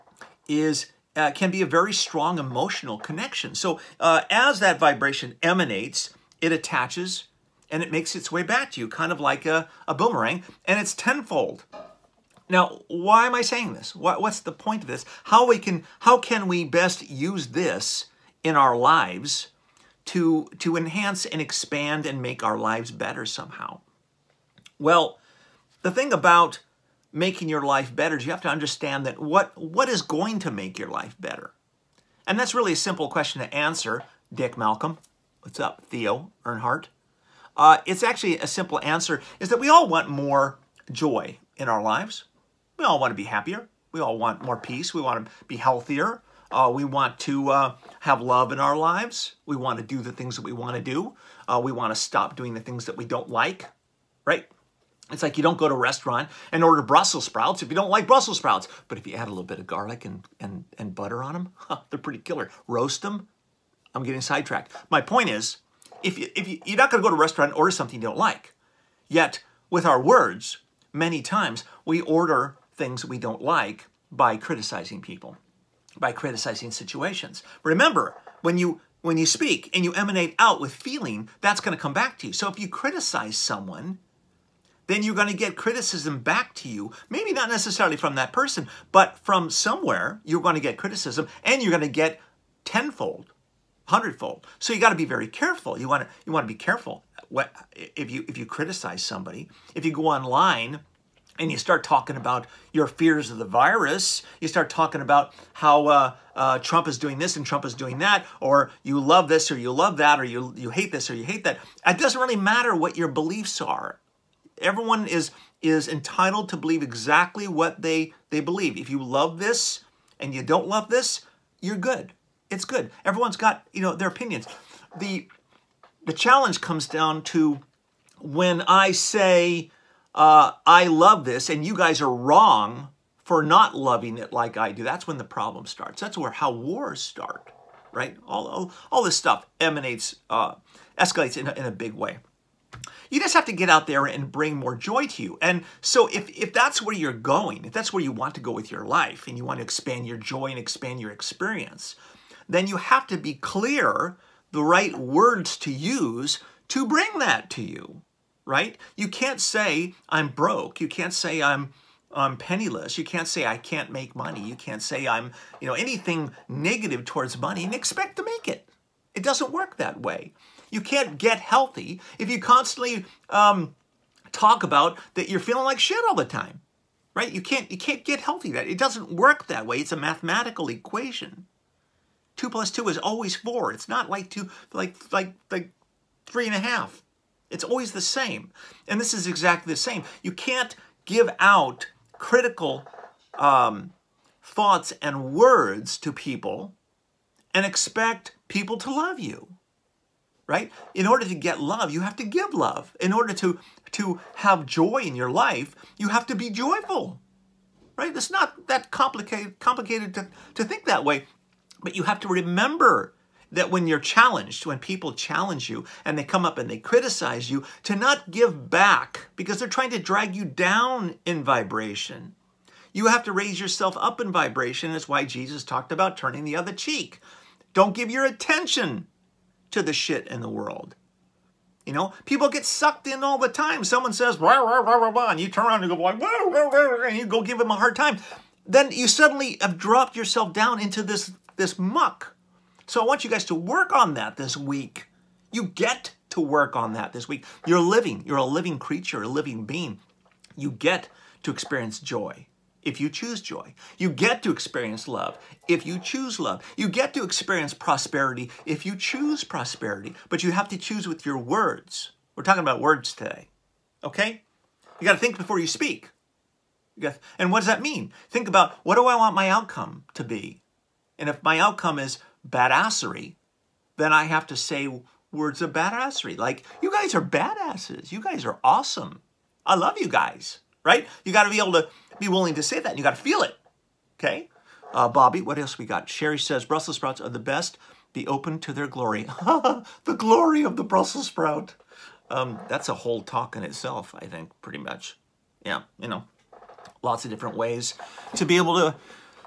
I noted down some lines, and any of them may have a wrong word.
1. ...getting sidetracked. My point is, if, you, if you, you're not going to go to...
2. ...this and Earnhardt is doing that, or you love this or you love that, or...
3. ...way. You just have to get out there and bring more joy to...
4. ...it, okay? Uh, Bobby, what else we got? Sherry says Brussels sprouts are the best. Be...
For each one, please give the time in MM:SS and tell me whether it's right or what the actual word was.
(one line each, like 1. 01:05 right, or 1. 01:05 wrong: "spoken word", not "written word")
1. 01:04 right
2. 01:47 wrong: "Trump", not "Earnhardt"
3. 02:21 right
4. 04:43 right.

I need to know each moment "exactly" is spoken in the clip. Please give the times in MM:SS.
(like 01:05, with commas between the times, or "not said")
01:56, 03:09.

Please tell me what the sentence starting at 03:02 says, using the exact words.
Two plus two is always four.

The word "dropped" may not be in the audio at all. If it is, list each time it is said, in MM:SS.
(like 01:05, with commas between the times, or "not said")
03:59.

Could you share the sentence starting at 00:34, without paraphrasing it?
Dick Malcolm, what's up, Theo Earnhardt?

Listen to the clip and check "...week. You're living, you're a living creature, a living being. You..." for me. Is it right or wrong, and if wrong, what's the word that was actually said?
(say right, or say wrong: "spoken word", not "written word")
right.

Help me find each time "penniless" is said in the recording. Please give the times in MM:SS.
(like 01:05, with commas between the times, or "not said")
02:42.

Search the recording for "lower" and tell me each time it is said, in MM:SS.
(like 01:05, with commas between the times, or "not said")
not said.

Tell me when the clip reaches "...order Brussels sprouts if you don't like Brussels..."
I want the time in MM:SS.
00:56.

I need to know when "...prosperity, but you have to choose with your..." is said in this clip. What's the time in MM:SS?
04:19.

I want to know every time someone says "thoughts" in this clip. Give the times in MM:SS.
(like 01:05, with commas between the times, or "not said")
03:14.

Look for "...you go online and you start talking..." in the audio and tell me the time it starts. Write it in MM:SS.
01:39.